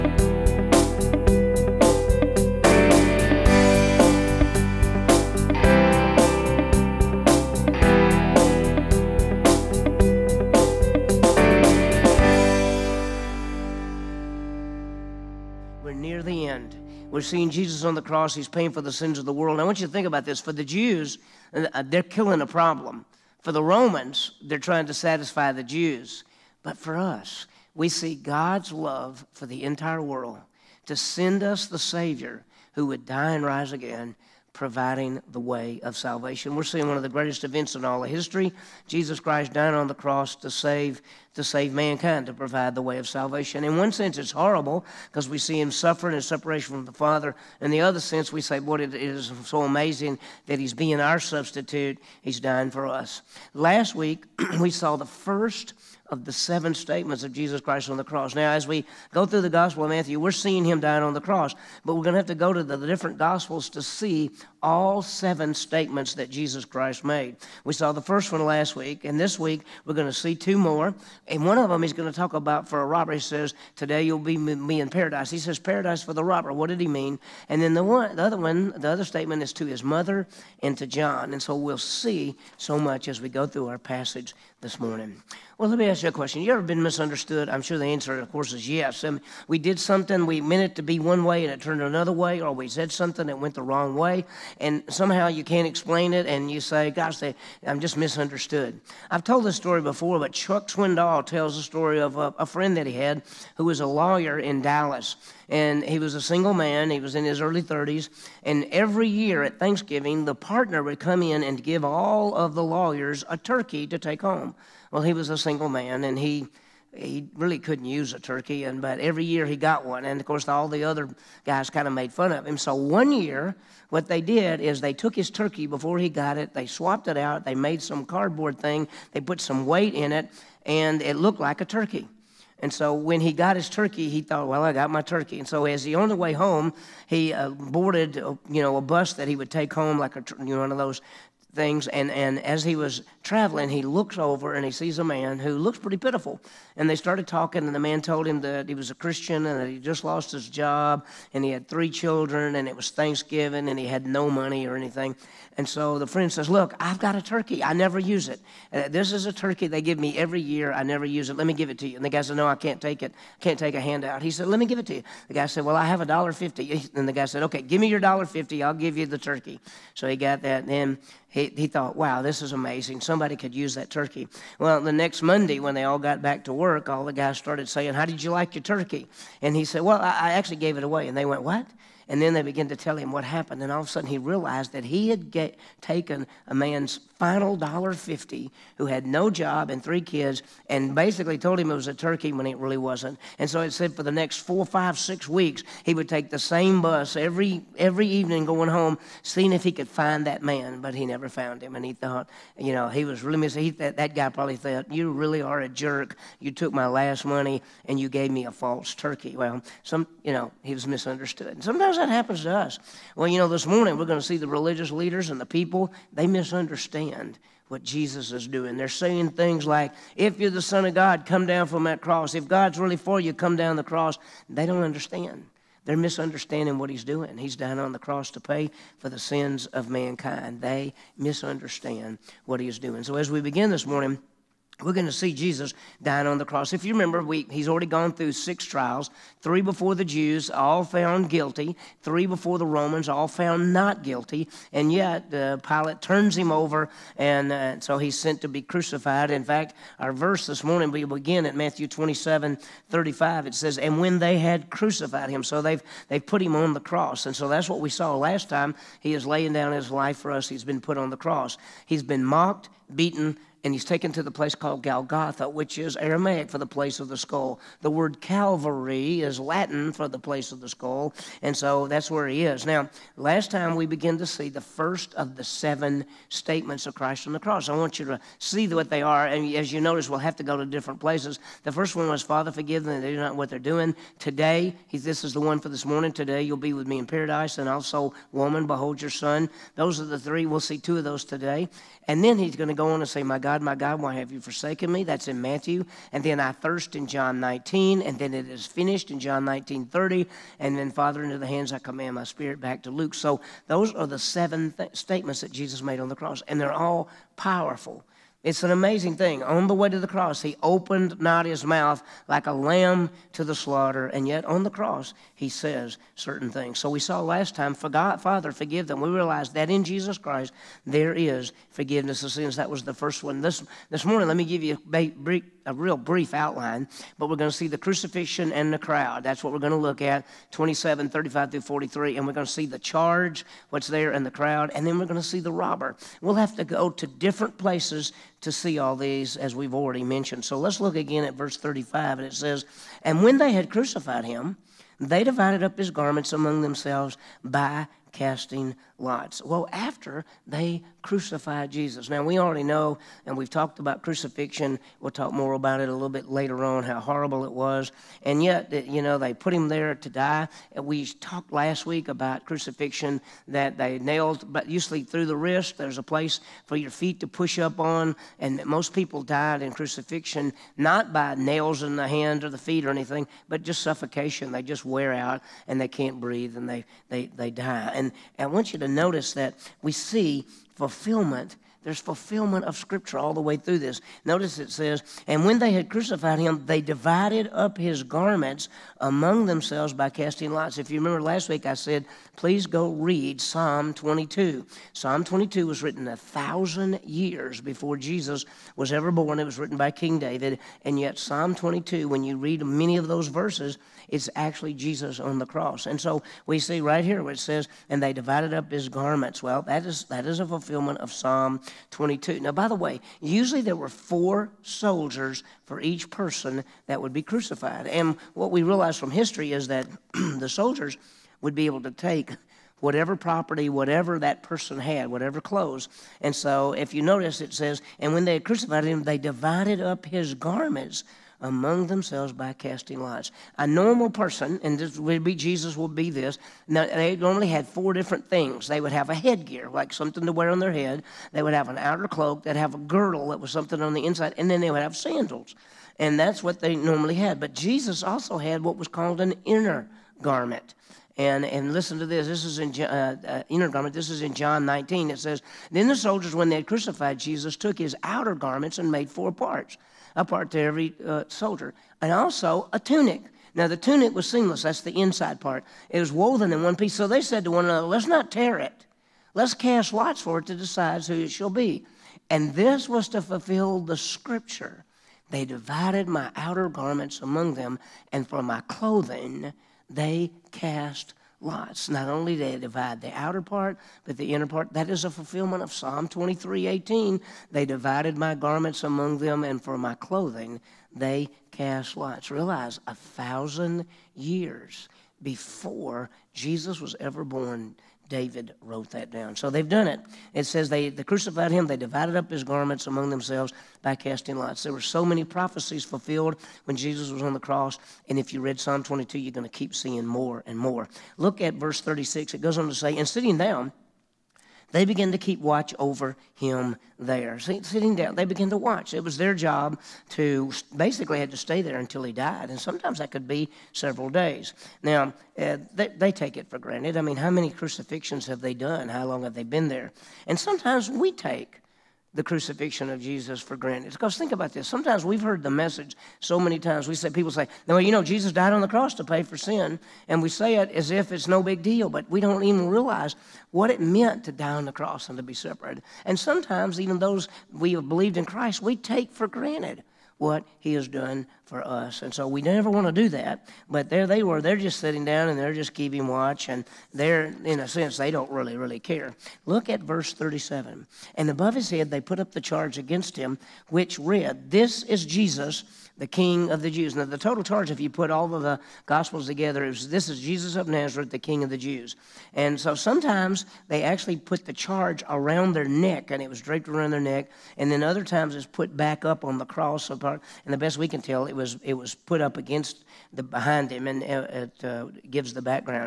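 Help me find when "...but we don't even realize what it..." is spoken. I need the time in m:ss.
9:01.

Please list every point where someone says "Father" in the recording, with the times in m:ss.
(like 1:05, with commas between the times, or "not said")
0:46, 4:42, 5:00, 5:18.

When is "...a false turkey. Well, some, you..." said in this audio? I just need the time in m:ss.
3:28.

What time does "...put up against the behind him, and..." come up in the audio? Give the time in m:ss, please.
9:41.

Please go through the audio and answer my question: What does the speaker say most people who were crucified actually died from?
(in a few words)
Suffocation.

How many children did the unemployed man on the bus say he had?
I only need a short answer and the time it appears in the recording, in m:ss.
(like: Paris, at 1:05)
3, at 2:31.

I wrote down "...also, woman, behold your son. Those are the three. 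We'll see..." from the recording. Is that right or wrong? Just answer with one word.
right.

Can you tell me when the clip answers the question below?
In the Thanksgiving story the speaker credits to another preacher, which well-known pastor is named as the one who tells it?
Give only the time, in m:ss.
1:40.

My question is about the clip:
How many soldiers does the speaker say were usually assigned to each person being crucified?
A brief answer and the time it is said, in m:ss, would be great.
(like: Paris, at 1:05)
4, at 6:53.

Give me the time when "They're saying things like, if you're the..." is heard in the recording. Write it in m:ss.
3:38.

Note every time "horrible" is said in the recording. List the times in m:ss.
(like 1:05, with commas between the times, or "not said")
0:44, 5:56.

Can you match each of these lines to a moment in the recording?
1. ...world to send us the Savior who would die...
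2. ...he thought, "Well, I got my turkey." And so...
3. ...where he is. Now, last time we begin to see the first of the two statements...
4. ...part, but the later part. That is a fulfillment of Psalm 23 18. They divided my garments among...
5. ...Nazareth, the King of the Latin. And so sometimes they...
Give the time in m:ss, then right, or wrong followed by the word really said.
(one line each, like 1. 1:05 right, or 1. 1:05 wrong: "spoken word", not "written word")
1. 0:30 right
2. 2:14 right
3. 4:32 wrong: "seven", not "two"
4. 8:03 wrong: "inner", not "later"
5. 9:30 wrong: "Jews", not "Latin".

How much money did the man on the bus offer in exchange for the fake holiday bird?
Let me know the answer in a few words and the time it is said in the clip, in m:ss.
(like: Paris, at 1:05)
$1.50, at 2:46.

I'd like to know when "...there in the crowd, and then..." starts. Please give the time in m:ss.
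5:33.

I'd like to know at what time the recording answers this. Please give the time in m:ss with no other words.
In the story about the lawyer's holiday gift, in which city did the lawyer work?
1:44.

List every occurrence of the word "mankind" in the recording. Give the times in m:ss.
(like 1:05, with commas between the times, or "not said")
0:41, 3:49.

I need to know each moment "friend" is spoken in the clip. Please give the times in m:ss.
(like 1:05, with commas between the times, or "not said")
1:42, 2:36.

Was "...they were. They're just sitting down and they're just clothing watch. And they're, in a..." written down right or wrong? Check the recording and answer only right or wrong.
wrong.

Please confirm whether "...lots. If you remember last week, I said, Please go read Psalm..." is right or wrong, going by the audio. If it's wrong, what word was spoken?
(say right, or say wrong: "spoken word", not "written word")
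right.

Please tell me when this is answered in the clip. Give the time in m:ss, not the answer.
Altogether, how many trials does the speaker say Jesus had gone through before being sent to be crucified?
3:58.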